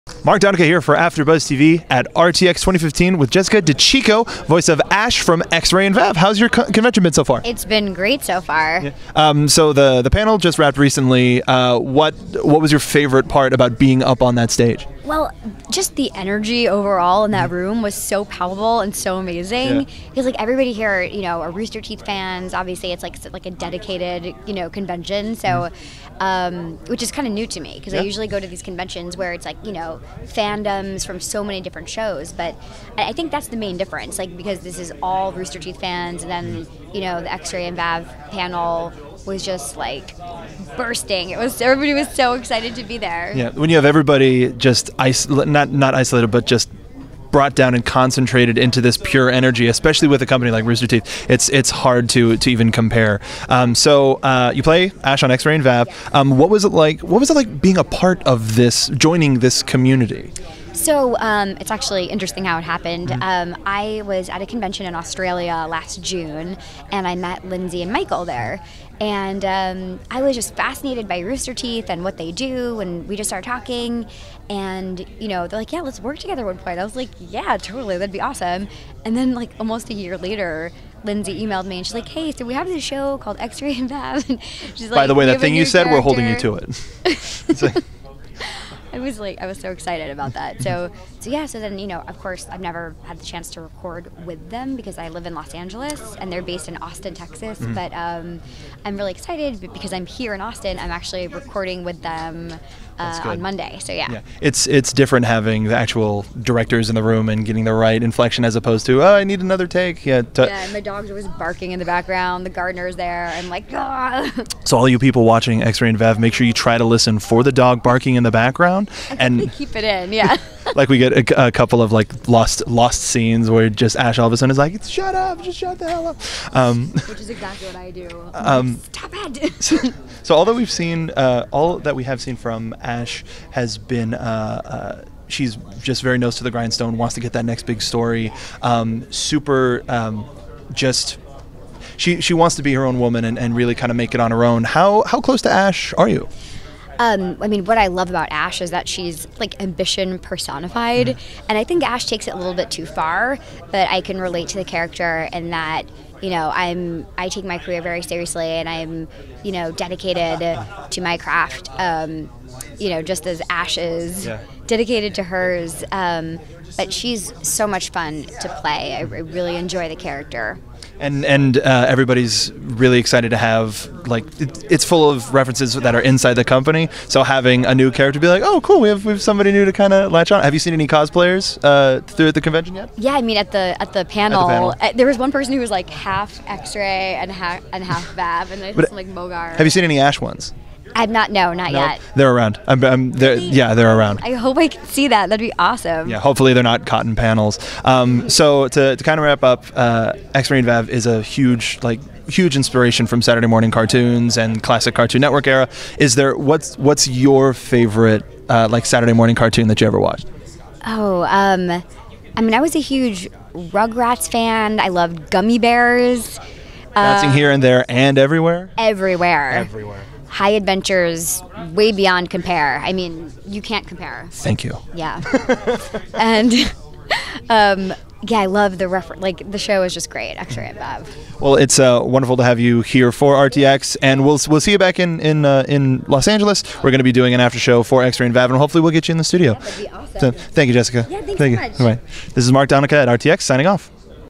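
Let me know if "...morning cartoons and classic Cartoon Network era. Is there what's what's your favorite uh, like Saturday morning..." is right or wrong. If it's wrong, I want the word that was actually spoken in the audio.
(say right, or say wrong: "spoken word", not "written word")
right.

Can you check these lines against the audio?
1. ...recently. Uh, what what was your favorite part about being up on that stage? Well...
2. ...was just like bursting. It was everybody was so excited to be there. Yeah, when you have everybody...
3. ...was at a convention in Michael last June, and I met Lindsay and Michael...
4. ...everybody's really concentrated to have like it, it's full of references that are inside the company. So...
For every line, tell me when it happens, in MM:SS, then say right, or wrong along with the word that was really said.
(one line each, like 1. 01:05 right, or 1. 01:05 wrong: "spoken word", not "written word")
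1. 00:10 right
2. 00:39 right
3. 01:04 wrong: "Australia", not "Michael"
4. 02:51 wrong: "excited", not "concentrated".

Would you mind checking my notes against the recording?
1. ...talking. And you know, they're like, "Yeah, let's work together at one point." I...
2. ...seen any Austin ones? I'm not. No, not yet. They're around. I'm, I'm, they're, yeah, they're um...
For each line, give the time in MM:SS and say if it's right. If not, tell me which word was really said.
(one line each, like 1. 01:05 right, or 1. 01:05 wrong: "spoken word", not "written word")
1. 01:13 right
2. 03:09 wrong: "Ash", not "Austin".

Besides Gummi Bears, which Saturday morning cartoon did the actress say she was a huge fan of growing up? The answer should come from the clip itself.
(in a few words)
Rugrats.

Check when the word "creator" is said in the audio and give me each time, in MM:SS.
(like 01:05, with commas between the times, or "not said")
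not said.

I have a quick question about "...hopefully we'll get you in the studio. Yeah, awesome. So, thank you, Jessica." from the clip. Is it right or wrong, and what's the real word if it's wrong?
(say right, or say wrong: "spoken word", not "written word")
right.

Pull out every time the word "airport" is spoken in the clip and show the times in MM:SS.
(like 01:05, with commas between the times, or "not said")
not said.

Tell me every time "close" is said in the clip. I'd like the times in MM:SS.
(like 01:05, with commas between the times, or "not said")
02:25.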